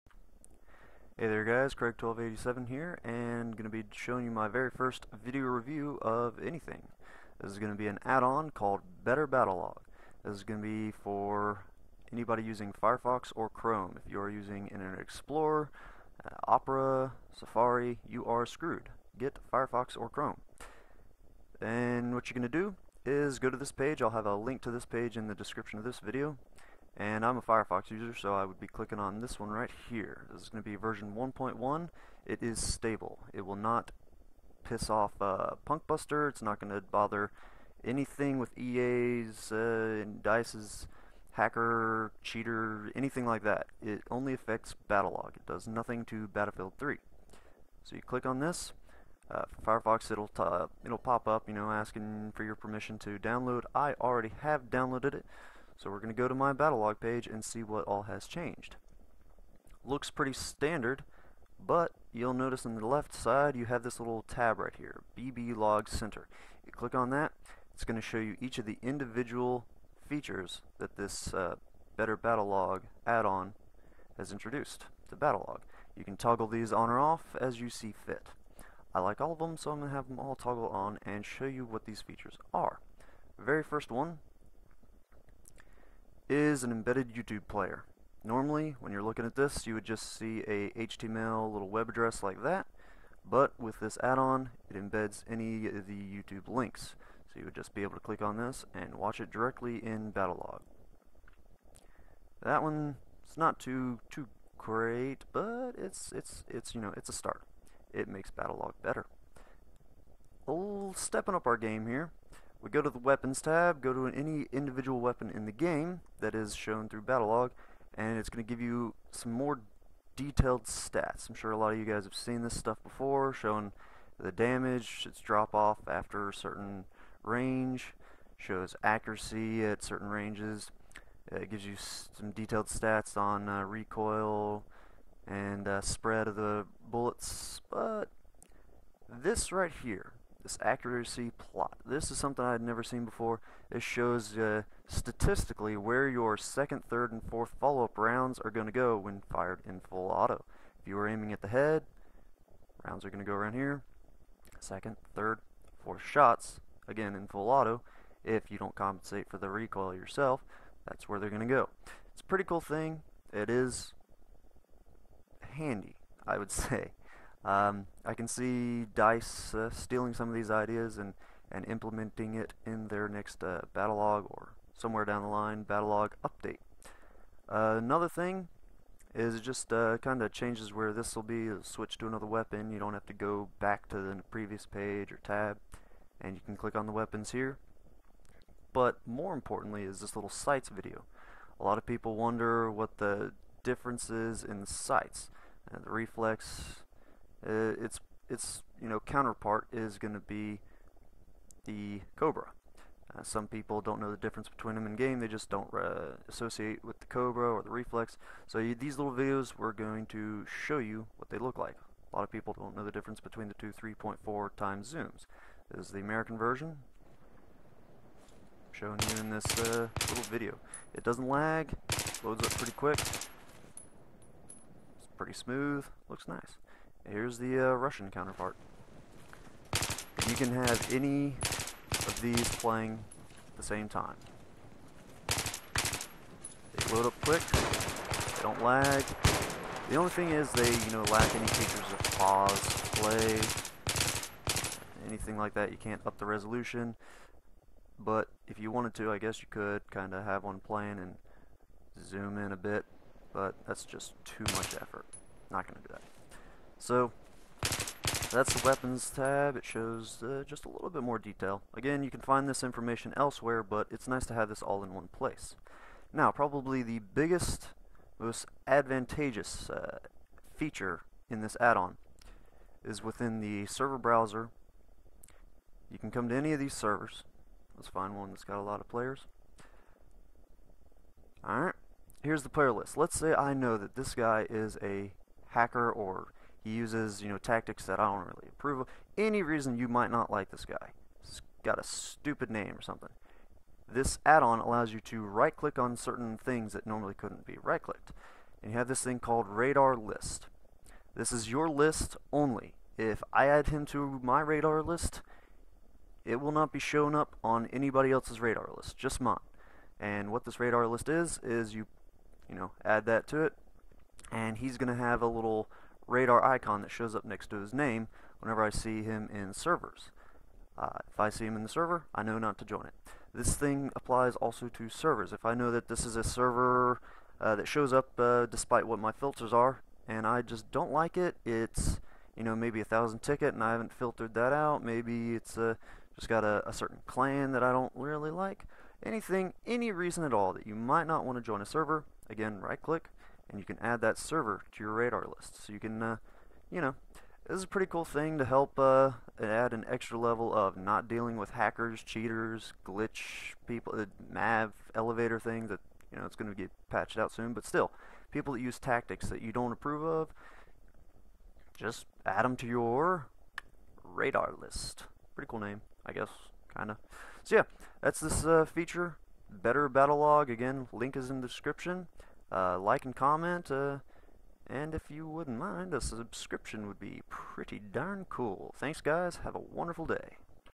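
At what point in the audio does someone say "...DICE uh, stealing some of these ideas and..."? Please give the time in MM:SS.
02:48.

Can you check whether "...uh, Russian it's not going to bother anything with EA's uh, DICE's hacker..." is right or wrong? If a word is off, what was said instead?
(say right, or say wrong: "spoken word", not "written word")
wrong: "Punkbuster", not "Russian".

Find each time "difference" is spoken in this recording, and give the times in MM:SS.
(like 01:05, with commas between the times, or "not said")
03:13, 03:24, 03:32.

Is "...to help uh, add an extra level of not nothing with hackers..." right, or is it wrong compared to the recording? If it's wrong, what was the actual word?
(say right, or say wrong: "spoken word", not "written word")
wrong: "dealing", not "nothing".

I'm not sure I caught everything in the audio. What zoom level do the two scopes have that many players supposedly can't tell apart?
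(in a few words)
3.4 times.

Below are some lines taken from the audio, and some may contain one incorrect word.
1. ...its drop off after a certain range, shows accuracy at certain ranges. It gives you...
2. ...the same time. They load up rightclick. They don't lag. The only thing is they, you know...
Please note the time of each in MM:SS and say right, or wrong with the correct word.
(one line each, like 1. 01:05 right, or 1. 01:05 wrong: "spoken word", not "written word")
1. 02:05 right
2. 03:53 wrong: "quick", not "rightclick".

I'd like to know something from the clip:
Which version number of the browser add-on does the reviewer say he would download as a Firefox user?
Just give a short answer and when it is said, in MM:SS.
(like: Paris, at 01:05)
1.1, at 00:30.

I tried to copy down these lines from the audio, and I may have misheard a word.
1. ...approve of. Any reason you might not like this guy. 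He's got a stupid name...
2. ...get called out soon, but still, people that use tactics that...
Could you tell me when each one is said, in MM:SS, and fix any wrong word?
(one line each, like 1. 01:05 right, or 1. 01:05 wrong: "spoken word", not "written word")
1. 04:48 right
2. 05:56 wrong: "patched", not "called".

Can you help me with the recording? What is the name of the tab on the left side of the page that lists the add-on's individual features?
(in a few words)
BB Log Center.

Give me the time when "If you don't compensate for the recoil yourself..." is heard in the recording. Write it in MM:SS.
02:38.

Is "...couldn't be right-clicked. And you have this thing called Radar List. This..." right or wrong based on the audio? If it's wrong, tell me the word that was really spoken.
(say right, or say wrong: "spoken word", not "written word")
right.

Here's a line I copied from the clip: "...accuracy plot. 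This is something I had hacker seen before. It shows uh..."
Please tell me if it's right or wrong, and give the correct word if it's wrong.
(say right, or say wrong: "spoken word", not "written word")
wrong: "never", not "hacker".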